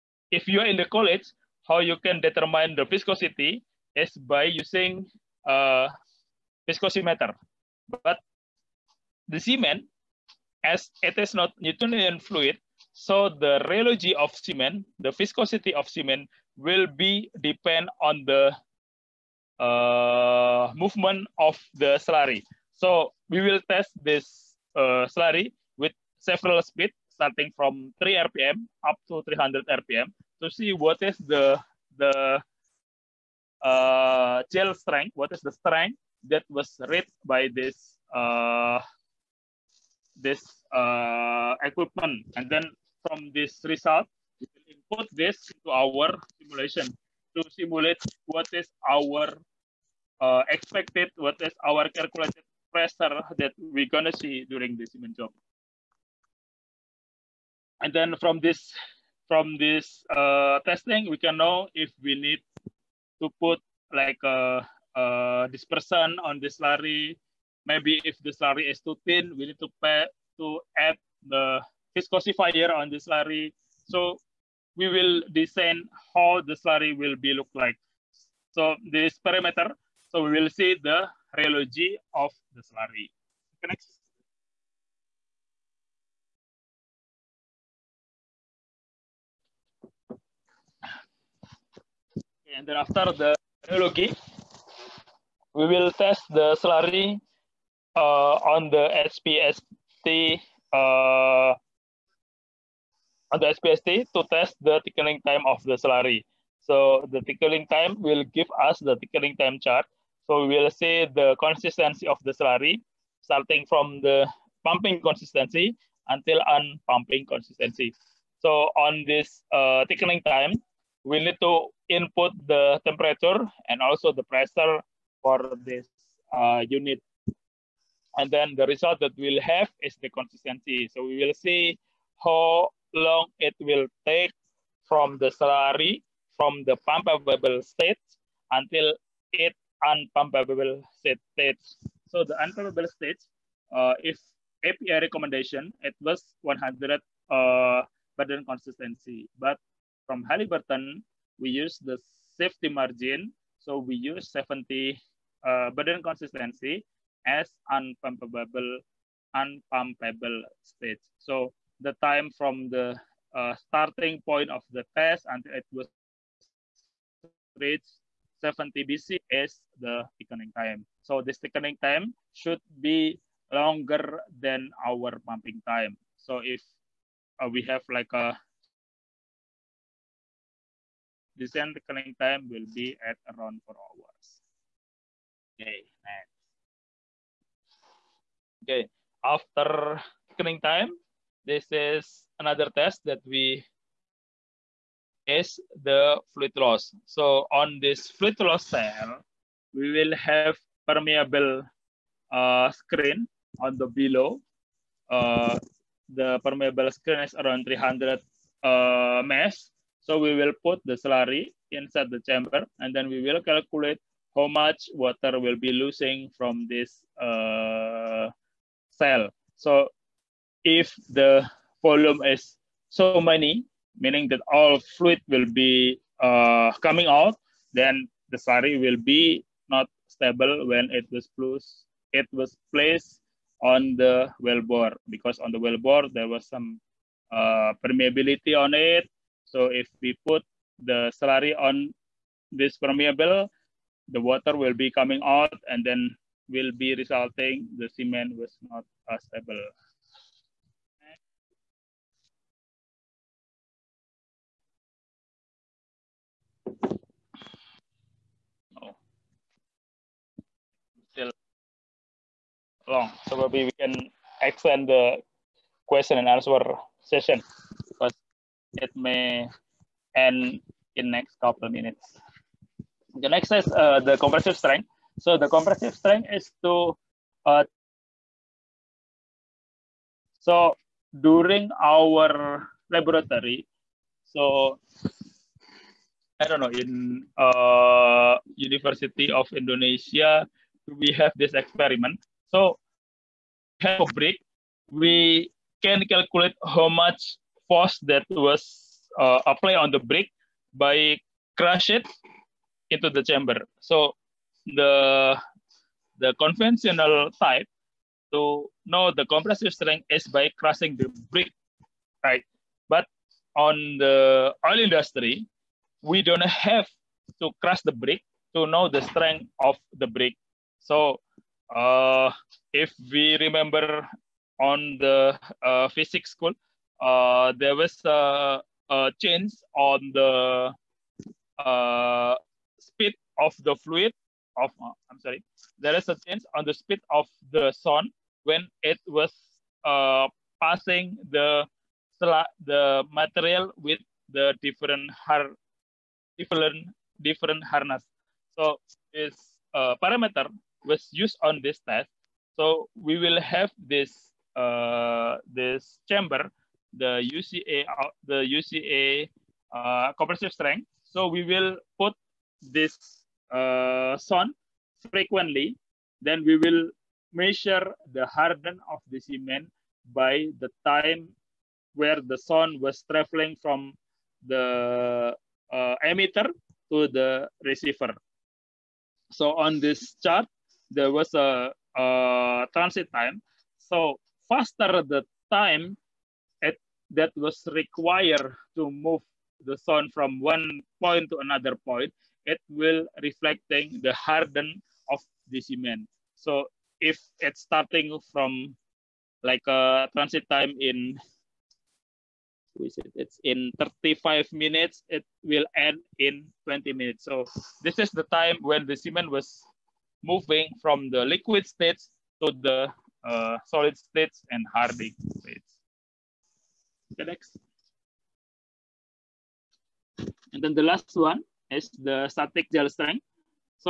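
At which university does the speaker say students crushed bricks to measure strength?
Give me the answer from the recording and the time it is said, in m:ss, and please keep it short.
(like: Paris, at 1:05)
University of Indonesia, at 4:48.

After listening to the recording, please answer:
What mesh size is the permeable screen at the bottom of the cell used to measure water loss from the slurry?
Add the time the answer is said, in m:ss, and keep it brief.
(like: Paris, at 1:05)
300 mesh, at 3:27.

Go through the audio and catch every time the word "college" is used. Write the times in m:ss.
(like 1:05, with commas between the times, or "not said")
0:00.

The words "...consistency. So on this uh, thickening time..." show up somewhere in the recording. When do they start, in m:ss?
1:57.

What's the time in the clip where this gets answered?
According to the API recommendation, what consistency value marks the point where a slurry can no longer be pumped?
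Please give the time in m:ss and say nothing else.
2:26.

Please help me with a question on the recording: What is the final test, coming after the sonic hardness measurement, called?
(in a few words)
static gel strength.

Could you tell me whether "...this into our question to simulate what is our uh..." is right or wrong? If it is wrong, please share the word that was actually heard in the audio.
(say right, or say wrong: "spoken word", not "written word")
wrong: "simulation", not "question".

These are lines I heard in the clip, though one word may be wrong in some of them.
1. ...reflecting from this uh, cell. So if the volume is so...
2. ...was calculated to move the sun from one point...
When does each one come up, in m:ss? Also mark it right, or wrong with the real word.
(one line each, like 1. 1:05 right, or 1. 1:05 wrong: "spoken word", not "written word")
1. 3:35 wrong: "losing", not "reflecting"
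2. 6:27 wrong: "required", not "calculated".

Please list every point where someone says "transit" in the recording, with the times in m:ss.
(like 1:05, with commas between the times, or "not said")
6:22, 6:40.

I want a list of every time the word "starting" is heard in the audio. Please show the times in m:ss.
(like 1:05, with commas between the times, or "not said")
0:27, 1:53, 2:43, 6:37.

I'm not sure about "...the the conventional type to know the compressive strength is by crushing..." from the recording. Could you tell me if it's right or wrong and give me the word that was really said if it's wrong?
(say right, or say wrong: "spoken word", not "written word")
right.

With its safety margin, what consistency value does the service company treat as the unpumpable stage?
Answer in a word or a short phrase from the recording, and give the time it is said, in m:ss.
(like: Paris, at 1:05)
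70 Bc, at 2:34.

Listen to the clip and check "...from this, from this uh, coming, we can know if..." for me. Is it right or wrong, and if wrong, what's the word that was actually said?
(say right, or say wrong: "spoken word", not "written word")
wrong: "testing", not "coming".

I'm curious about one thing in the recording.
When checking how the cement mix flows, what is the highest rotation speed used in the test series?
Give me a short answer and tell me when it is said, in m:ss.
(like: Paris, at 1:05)
300 RPM, at 0:29.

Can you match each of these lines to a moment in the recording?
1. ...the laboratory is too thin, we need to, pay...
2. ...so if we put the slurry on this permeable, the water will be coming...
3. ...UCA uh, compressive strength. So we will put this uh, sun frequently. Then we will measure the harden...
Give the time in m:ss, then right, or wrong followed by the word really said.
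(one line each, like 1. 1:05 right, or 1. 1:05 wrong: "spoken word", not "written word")
1. 1:08 wrong: "slurry", not "laboratory"
2. 3:59 right
3. 5:58 right.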